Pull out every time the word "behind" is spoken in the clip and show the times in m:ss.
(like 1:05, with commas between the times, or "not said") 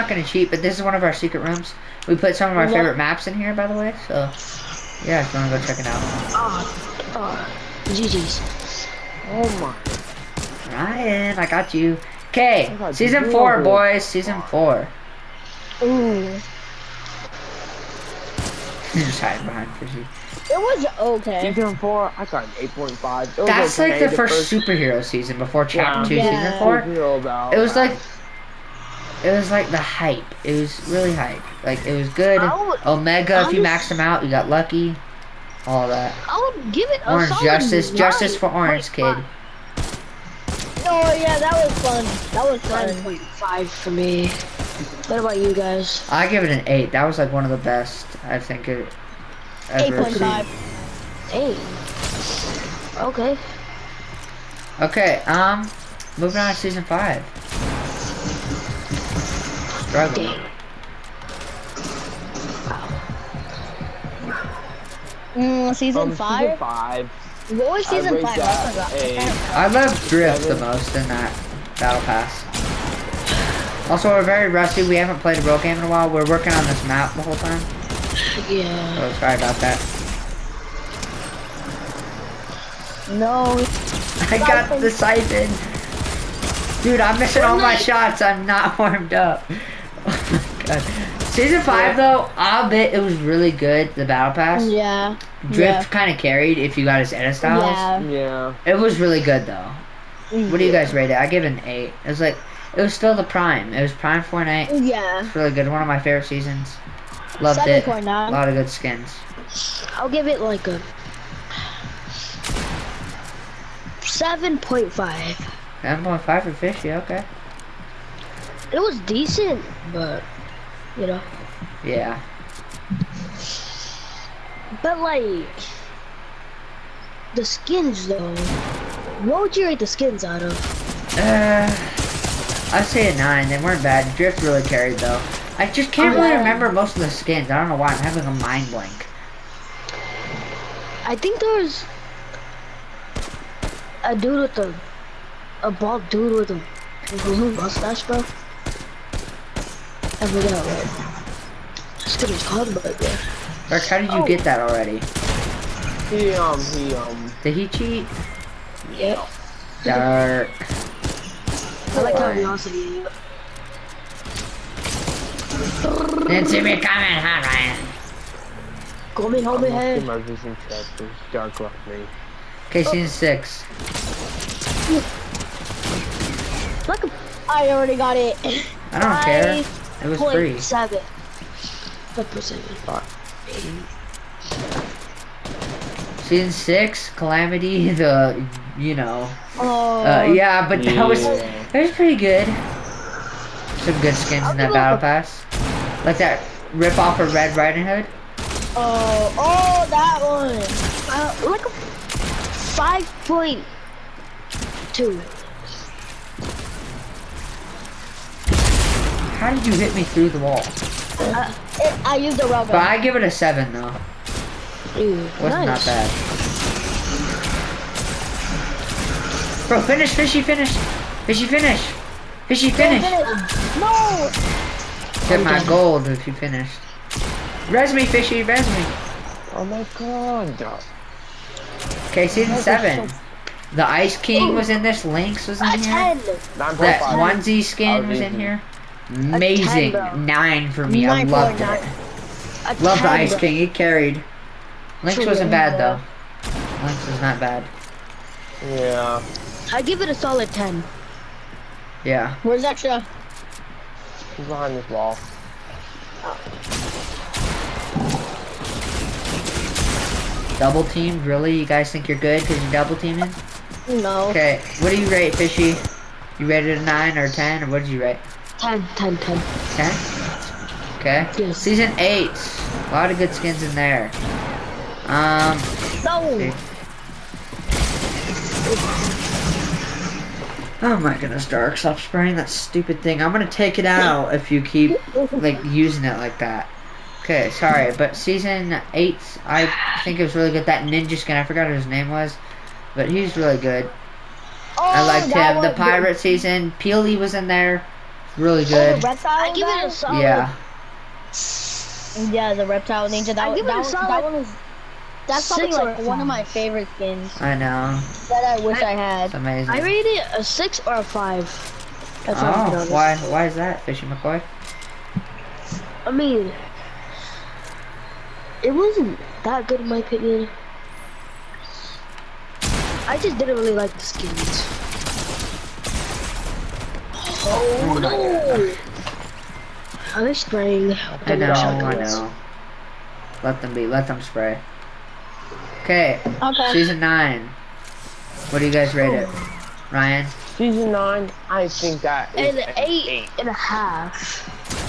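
0:19, 4:14.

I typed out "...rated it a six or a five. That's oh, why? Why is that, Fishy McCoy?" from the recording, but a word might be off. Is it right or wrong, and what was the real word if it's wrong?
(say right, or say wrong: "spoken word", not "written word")
right.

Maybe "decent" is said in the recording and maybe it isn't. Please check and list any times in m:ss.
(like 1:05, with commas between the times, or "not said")
1:59.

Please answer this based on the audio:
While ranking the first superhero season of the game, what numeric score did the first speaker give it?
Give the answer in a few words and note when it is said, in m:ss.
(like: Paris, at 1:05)
8.5, at 0:22.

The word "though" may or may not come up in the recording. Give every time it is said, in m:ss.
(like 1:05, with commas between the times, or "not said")
1:31, 1:39, 2:08, 2:14, 3:33, 4:05.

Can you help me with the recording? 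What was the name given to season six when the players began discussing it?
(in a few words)
Calamity.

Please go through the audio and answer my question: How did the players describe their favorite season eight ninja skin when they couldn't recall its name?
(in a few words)
reptile ninja.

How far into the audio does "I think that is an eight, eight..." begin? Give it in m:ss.
5:41.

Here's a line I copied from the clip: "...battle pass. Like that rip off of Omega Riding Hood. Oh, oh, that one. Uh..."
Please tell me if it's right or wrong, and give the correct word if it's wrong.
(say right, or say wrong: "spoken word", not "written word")
wrong: "Red", not "Omega".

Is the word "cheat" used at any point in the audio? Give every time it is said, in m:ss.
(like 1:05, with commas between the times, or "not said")
0:00, 2:37.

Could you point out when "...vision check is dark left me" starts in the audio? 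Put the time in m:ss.
2:50.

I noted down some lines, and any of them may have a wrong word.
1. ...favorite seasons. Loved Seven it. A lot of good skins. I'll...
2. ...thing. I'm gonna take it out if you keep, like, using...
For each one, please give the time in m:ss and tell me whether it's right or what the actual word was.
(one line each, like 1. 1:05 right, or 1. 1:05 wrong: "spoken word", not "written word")
1. 1:45 right
2. 4:43 right.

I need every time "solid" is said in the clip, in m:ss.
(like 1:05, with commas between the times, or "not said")
4:10, 4:59, 5:03.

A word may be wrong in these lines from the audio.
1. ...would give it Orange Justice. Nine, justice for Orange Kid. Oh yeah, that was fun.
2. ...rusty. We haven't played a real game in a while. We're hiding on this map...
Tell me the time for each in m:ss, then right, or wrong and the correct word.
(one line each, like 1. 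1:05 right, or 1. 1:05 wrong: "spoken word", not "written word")
1. 0:36 right
2. 1:14 wrong: "working", not "hiding".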